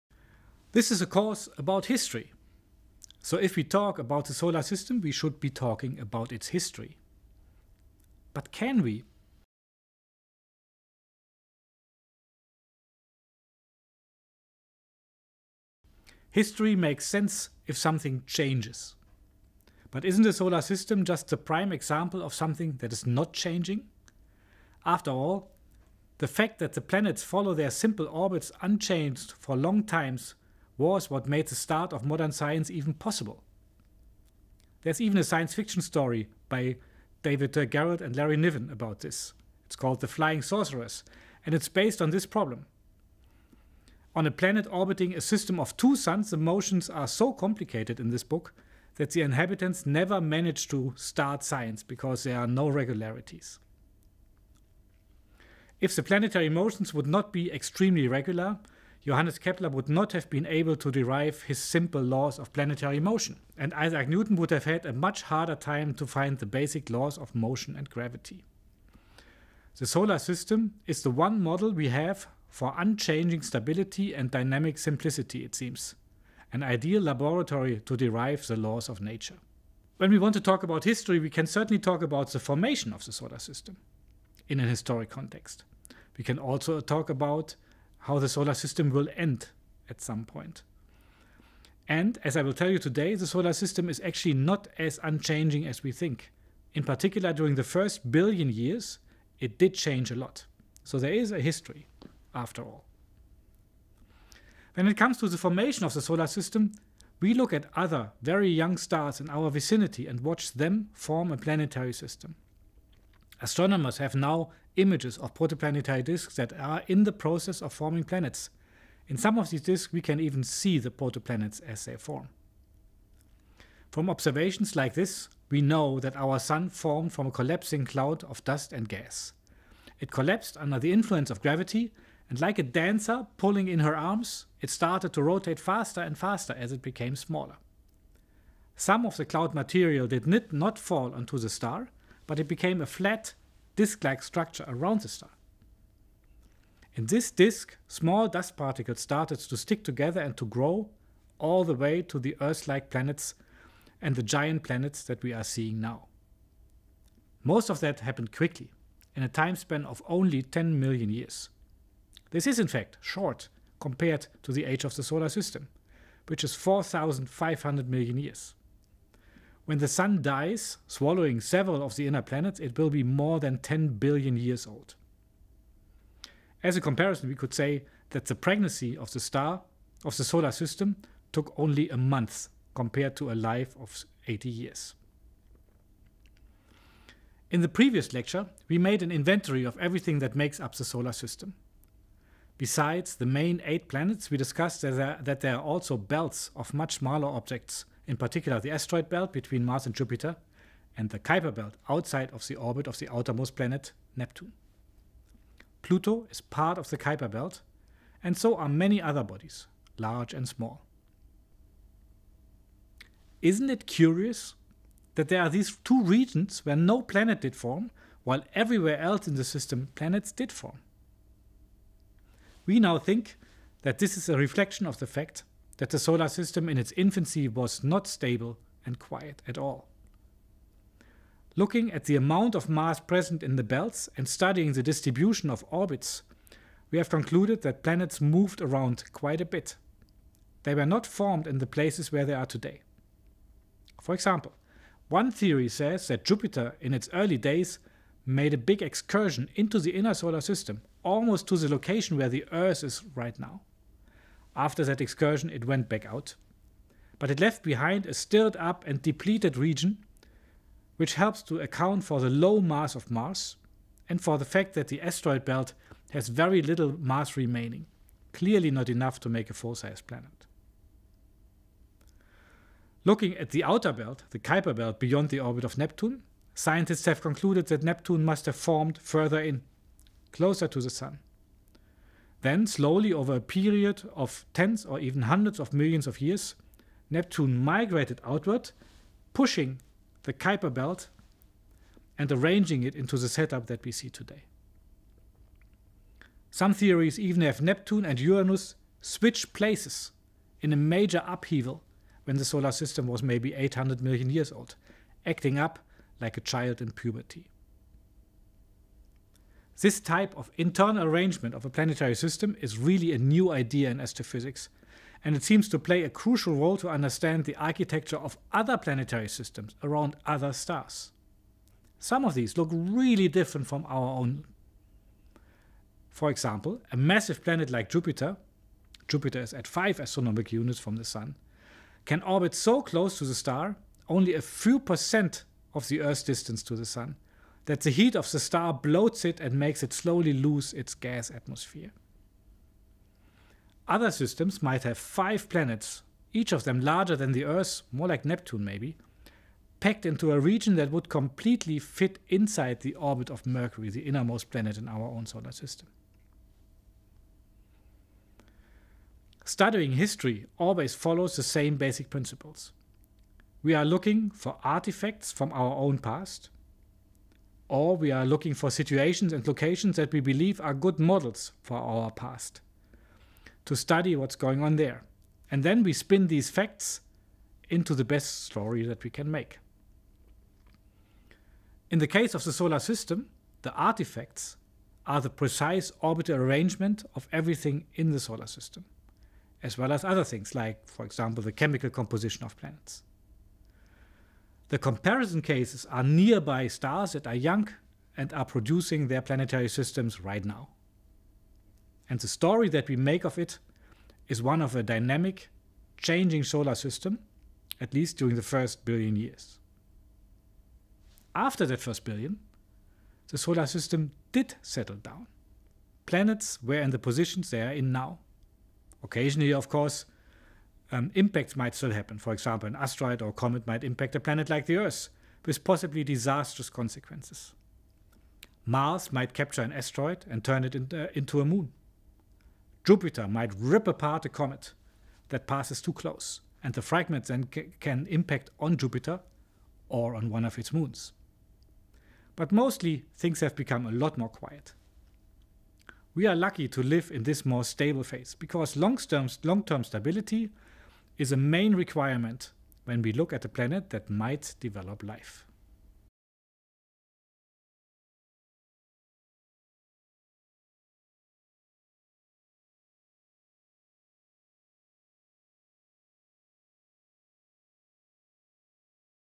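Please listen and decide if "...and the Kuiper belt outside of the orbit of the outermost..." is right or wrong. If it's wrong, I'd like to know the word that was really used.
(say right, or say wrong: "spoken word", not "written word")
right.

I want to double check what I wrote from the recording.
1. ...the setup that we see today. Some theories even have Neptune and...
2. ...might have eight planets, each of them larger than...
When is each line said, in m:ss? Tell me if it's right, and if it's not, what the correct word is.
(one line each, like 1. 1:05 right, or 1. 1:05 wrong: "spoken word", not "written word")
1. 4:53 right
2. 5:44 wrong: "five", not "eight".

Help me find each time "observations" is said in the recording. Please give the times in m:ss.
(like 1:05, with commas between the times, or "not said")
2:04.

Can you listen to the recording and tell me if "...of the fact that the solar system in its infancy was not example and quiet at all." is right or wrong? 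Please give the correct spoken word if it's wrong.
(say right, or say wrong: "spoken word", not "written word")
wrong: "stable", not "example".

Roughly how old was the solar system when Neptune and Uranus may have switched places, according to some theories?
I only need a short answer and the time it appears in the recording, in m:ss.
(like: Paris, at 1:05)
800 million years, at 5:03.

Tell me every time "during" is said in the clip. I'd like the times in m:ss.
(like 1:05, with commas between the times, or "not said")
1:37, 6:48.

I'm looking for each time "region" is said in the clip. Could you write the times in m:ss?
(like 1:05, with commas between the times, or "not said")
3:36, 4:19, 5:50.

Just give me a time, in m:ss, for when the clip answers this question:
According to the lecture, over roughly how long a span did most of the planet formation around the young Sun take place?
2:40.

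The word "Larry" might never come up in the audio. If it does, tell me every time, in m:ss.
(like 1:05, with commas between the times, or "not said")
0:38.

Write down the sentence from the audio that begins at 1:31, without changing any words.
And as I will tell you today, the solar system is actually not as unchanging as we think.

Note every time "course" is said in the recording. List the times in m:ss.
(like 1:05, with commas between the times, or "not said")
0:01, 6:59.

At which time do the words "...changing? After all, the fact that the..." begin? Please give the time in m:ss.
0:23.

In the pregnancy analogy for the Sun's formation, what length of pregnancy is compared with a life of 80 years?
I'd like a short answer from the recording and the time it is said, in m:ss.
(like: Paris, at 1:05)
a month, at 3:01.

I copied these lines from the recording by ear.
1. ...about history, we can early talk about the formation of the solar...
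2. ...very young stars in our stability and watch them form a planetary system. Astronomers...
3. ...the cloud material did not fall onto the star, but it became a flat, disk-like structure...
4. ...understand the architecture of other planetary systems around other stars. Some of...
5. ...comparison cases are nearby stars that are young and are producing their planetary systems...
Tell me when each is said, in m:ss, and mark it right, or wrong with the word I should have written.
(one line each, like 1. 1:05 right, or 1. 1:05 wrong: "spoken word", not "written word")
1. 1:20 wrong: "certainly", not "early"
2. 1:48 wrong: "vicinity", not "stability"
3. 2:19 right
4. 5:16 right
5. 6:34 right.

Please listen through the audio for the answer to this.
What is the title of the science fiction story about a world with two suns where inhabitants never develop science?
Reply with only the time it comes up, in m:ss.
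0:40.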